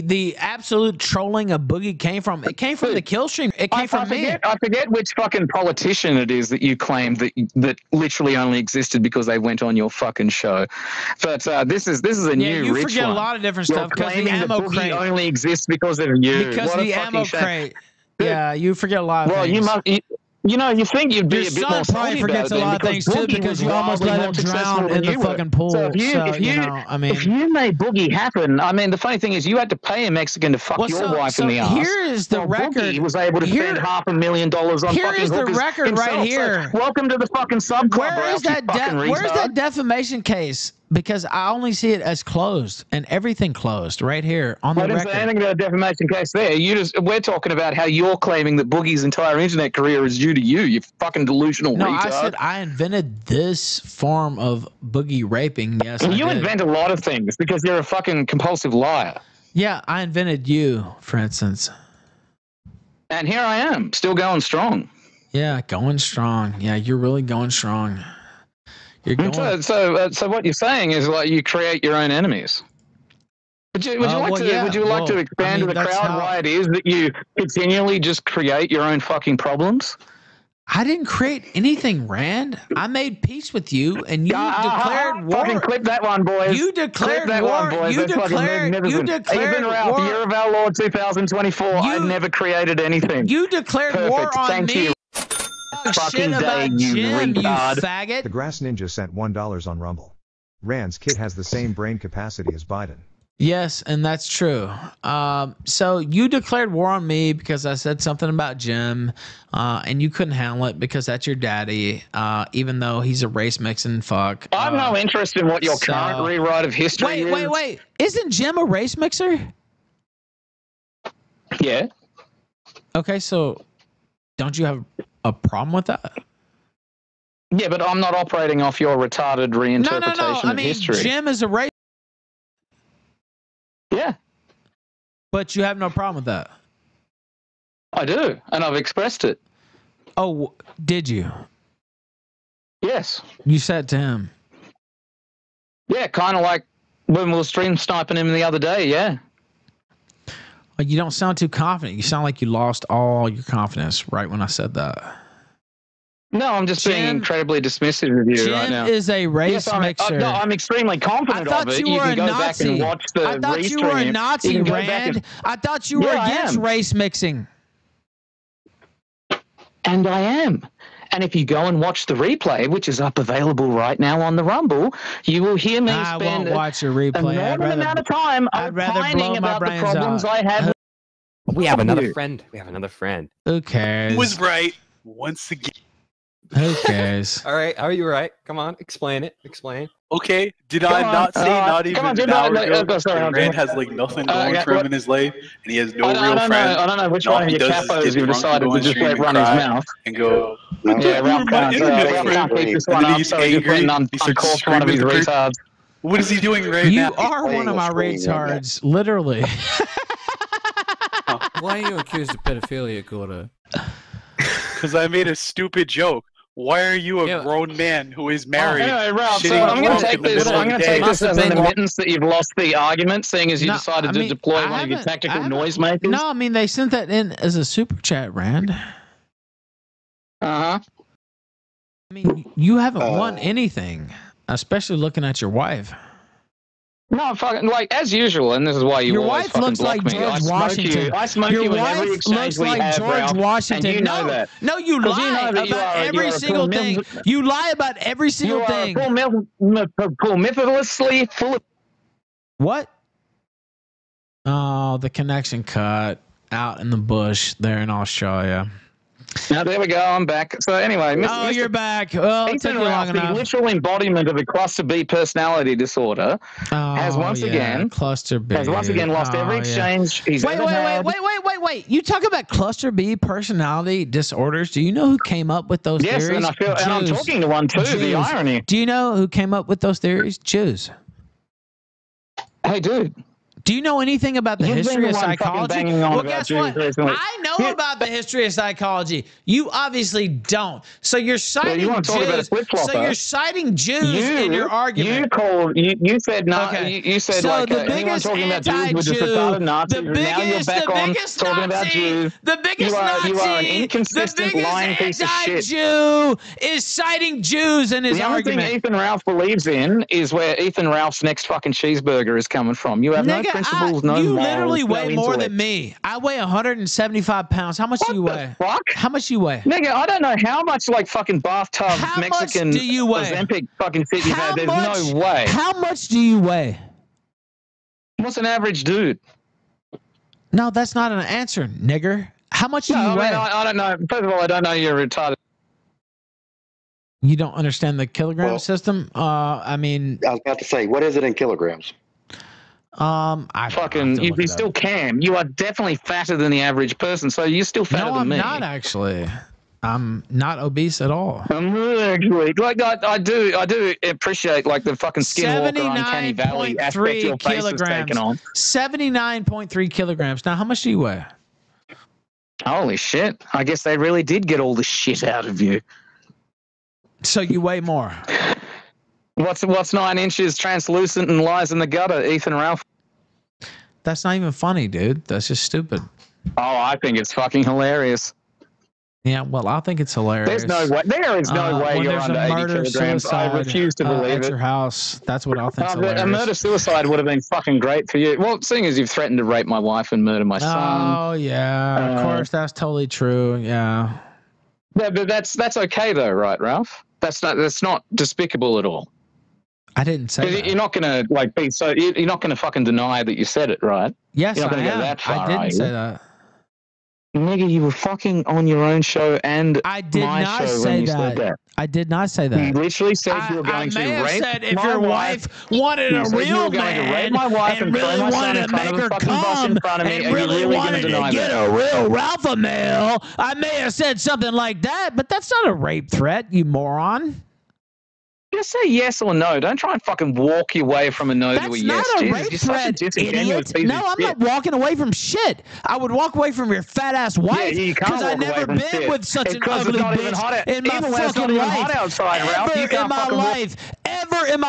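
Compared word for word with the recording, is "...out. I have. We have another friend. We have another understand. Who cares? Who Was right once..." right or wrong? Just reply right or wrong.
wrong.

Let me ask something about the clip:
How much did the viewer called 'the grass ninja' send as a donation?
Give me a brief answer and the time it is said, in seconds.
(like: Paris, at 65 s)
1 dollar, at 99 s.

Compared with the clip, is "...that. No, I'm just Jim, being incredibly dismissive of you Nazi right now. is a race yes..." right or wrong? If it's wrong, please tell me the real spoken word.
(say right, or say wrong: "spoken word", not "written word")
wrong: "Jim", not "Nazi".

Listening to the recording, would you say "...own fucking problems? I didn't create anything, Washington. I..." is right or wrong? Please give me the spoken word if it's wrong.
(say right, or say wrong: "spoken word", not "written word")
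wrong: "Rand", not "Washington".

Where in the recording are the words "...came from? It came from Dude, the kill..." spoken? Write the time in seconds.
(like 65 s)
1 s.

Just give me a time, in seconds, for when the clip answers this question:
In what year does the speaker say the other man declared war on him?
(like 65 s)
90 s.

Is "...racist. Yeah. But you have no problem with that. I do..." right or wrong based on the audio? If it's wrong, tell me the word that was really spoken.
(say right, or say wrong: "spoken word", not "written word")
right.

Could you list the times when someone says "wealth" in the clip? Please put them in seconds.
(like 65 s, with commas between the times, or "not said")
not said.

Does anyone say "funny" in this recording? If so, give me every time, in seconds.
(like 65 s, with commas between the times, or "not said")
28 s, 374 s.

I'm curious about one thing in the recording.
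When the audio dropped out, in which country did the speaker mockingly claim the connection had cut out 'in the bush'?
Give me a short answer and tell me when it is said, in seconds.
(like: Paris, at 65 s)
Australia, at 257 s.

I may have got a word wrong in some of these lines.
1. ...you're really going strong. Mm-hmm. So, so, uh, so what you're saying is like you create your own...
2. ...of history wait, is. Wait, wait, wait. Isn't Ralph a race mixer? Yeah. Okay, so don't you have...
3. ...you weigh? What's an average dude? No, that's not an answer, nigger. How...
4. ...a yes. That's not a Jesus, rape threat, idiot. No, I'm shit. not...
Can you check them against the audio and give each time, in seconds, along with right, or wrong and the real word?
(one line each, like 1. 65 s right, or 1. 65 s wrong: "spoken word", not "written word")
1. 66 s right
2. 116 s wrong: "Jim", not "Ralph"
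3. 326 s right
4. 431 s right.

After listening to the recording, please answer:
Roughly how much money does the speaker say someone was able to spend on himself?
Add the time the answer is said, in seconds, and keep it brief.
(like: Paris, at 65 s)
half a million dollars, at 33 s.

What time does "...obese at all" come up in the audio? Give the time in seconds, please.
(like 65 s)
350 s.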